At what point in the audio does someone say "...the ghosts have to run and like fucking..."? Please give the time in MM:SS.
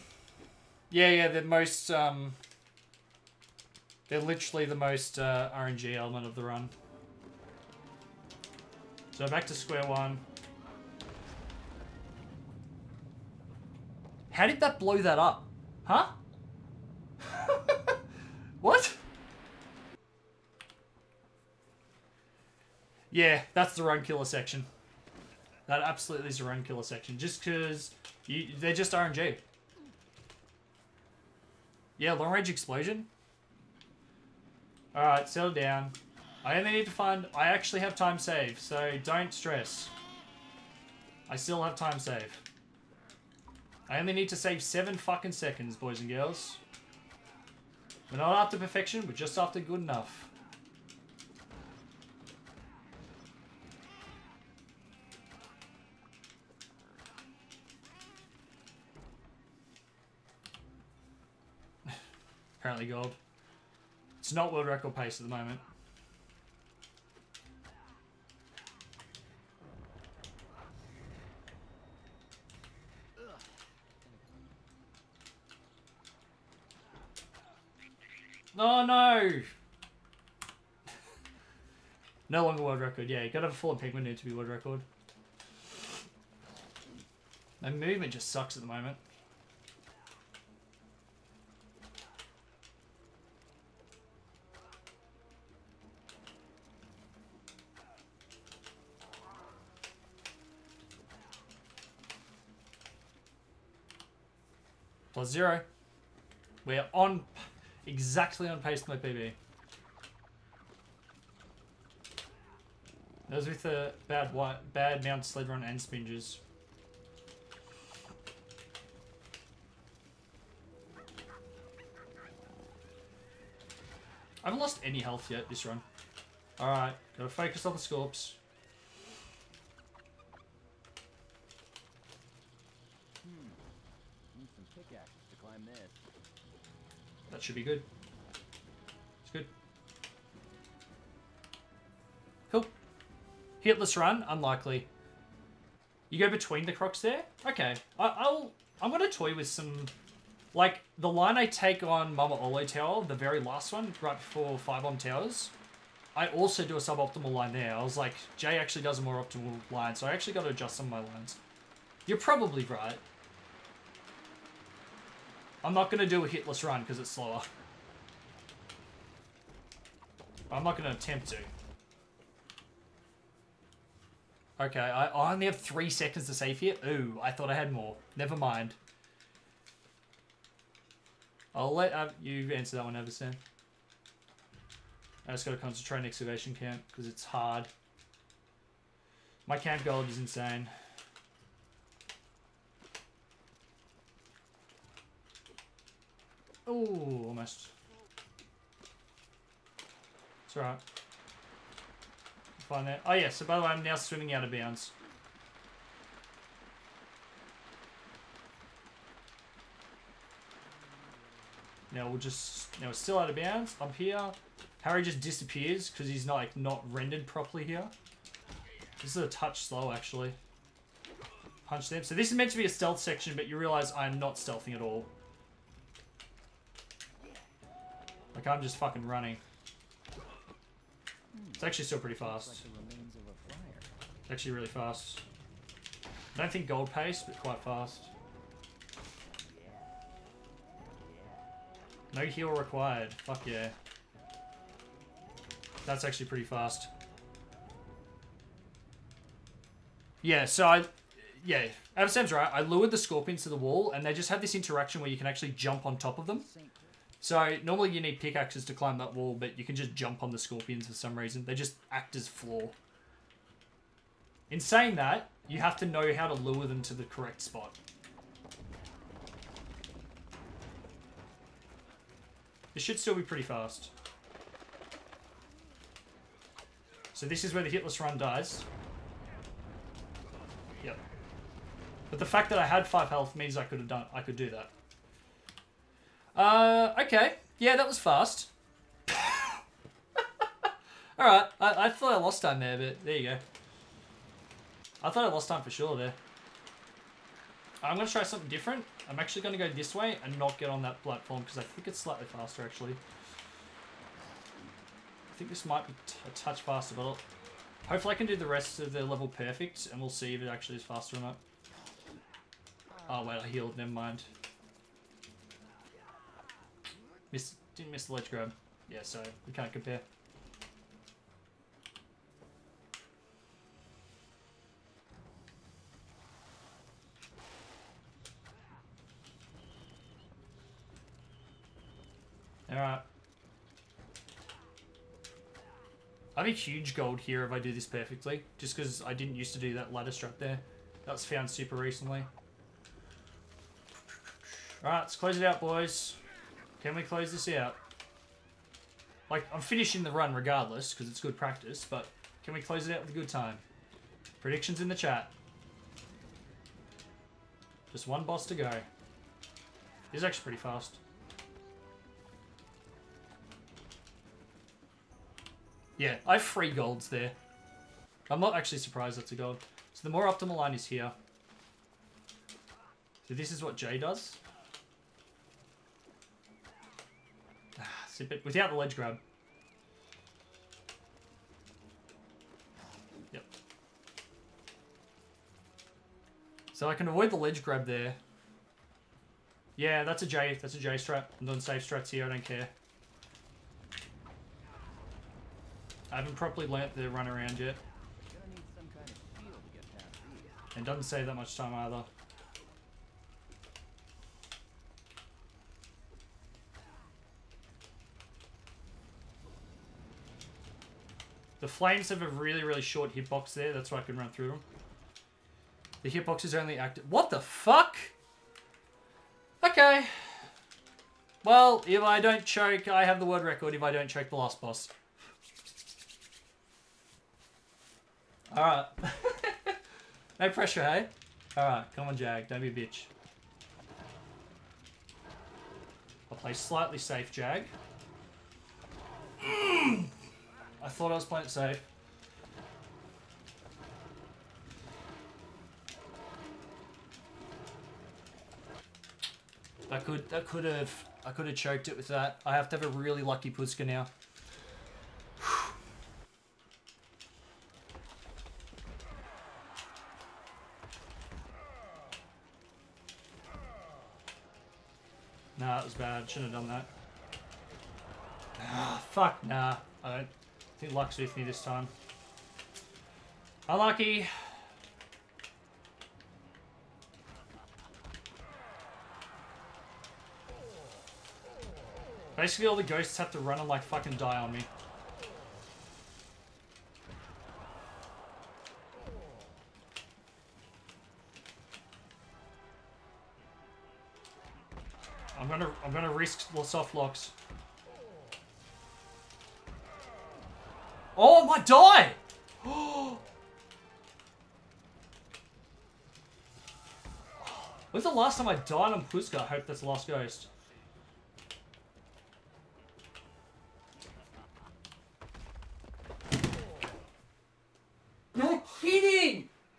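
08:02.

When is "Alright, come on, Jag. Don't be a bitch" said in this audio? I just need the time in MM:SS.
07:11.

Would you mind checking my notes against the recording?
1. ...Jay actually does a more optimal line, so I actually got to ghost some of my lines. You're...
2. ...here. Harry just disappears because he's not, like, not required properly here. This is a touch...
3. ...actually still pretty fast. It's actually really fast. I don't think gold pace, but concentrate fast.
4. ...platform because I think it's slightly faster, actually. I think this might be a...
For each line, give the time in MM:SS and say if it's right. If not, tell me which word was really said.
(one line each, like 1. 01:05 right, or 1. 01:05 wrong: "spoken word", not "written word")
1. 02:38 wrong: "adjust", not "ghost"
2. 03:33 wrong: "rendered", not "required"
3. 03:51 wrong: "quite", not "concentrate"
4. 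05:01 right.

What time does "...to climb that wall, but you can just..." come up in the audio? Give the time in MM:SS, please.
04:18.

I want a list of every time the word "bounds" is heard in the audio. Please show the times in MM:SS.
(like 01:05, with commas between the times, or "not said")
03:24, 03:33.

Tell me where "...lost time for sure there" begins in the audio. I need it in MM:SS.
04:55.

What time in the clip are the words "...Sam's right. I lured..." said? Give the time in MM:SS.
04:12.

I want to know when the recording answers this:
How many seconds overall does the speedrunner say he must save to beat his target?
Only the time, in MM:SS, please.
00:44.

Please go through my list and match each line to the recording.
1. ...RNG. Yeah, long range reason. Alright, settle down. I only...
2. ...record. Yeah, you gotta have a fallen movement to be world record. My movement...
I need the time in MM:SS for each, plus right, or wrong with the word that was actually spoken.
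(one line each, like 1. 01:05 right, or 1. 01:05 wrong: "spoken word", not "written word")
1. 00:28 wrong: "explosion", not "reason"
2. 01:22 wrong: "pigment", not "movement".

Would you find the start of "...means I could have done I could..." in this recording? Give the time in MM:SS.
04:43.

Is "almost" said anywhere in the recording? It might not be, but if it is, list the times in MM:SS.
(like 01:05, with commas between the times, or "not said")
03:17.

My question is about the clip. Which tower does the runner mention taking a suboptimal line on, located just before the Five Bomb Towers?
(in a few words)
Mama Oullo Tower.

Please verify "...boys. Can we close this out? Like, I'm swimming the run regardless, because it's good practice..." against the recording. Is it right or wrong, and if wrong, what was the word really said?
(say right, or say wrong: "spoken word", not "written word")
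wrong: "finishing", not "swimming".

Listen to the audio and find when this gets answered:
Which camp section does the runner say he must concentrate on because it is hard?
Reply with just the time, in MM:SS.
03:06.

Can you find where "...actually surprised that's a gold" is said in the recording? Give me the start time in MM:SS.
06:08.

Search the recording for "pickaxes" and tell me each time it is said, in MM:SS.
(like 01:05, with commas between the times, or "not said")
02:14, 04:18.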